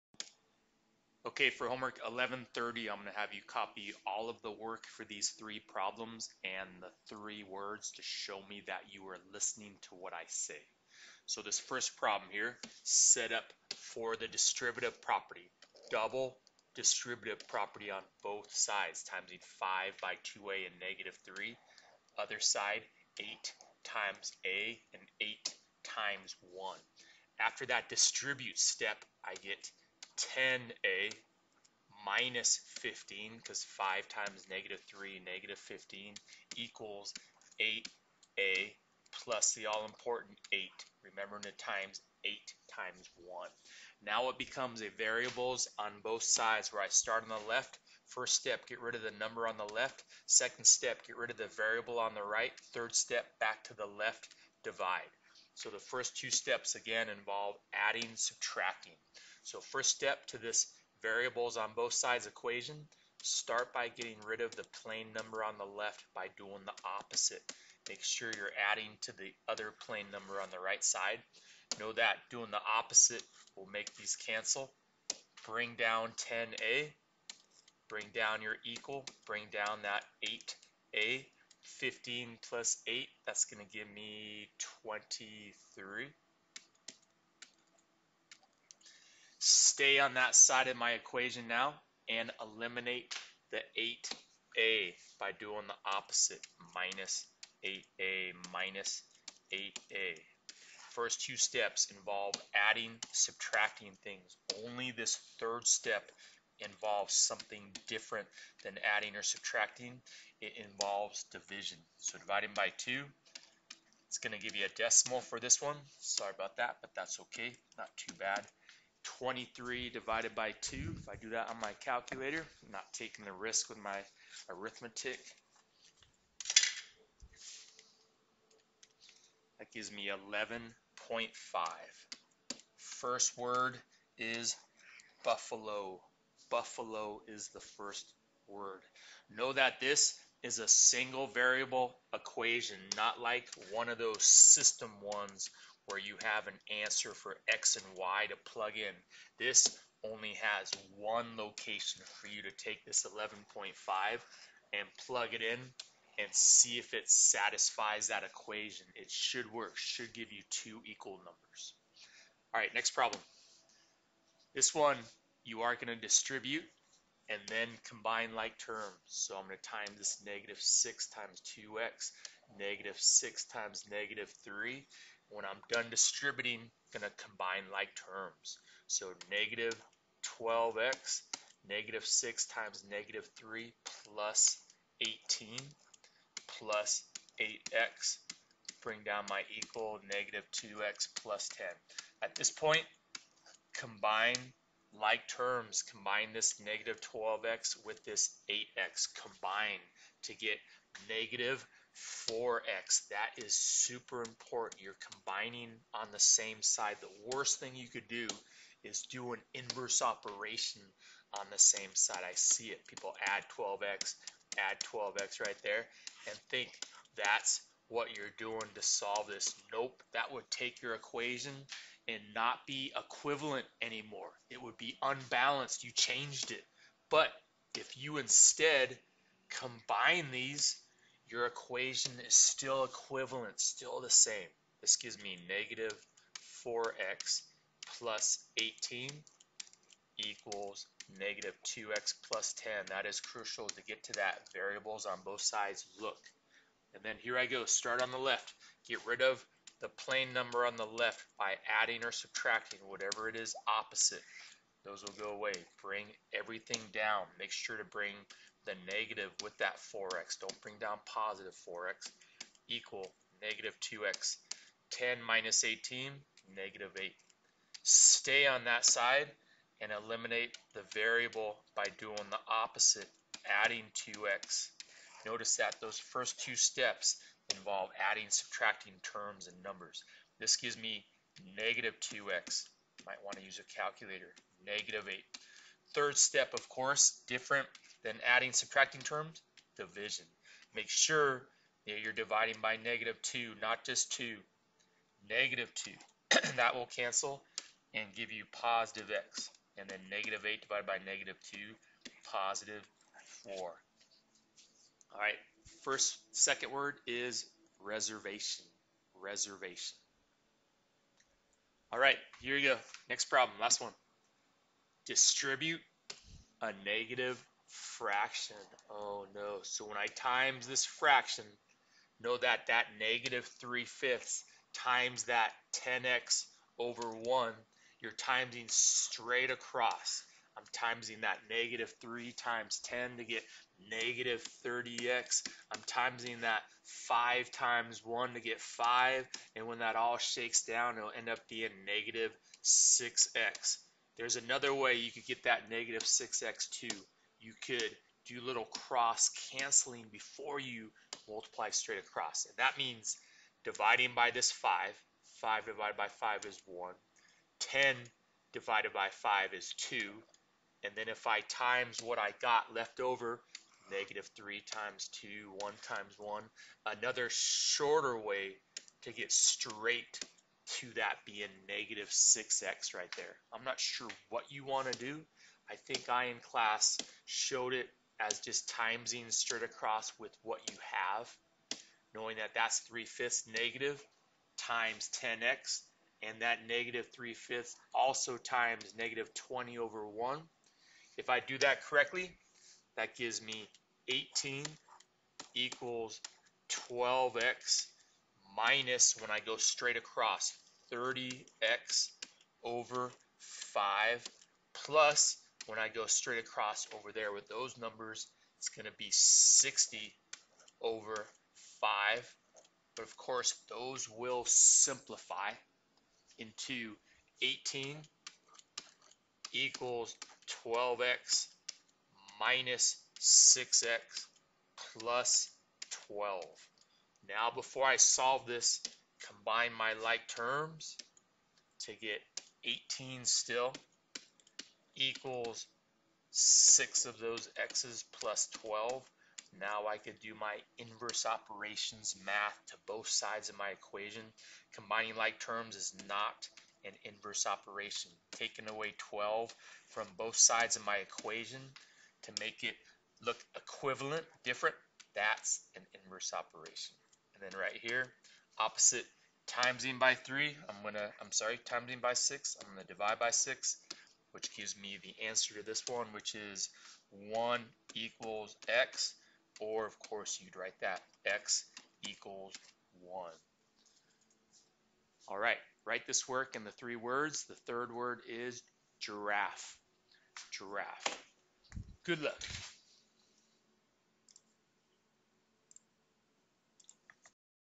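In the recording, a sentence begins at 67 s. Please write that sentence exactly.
Make sure you're adding to the other plain number on the right side.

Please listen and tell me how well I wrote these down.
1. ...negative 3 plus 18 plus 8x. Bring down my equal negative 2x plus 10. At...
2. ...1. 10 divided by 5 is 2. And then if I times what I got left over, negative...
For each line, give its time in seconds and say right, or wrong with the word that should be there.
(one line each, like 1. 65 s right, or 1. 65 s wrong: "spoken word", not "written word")
1. 182 s right
2. 356 s right.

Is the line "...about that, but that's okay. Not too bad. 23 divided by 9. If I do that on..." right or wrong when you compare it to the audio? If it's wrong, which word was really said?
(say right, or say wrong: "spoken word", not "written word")
wrong: "2", not "9".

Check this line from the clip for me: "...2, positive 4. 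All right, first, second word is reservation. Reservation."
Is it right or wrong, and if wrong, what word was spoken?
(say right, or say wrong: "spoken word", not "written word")
right.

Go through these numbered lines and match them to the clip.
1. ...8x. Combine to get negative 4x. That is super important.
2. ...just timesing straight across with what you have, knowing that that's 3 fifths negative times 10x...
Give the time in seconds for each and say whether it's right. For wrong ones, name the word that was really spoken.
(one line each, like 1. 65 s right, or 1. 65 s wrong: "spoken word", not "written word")
1. 198 s right
2. 378 s right.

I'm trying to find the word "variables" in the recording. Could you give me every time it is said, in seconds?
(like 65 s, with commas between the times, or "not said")
44 s, 51 s, 61 s, 141 s, 244 s, 270 s.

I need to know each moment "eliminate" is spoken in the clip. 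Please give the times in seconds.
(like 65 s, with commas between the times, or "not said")
92 s, 269 s.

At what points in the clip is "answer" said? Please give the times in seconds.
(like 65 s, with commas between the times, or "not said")
146 s, 465 s.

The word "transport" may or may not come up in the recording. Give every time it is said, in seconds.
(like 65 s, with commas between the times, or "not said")
not said.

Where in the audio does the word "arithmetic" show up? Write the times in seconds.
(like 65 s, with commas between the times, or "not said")
124 s.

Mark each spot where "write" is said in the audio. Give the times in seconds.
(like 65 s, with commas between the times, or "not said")
470 s, 475 s.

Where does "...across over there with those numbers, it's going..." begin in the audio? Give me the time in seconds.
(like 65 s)
406 s.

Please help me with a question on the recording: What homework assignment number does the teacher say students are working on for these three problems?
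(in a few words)
1130.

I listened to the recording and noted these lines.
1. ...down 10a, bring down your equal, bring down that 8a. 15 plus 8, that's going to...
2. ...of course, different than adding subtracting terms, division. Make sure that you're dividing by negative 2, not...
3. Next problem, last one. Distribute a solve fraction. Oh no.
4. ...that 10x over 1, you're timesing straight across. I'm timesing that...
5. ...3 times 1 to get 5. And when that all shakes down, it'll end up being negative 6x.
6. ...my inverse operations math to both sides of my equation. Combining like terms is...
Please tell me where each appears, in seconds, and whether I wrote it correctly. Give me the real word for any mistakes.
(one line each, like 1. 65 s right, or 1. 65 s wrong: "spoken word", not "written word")
1. 75 s right
2. 286 s right
3. 313 s wrong: "negative", not "solve"
4. 325 s right
5. 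337 s wrong: "5", not "3"
6. 440 s right.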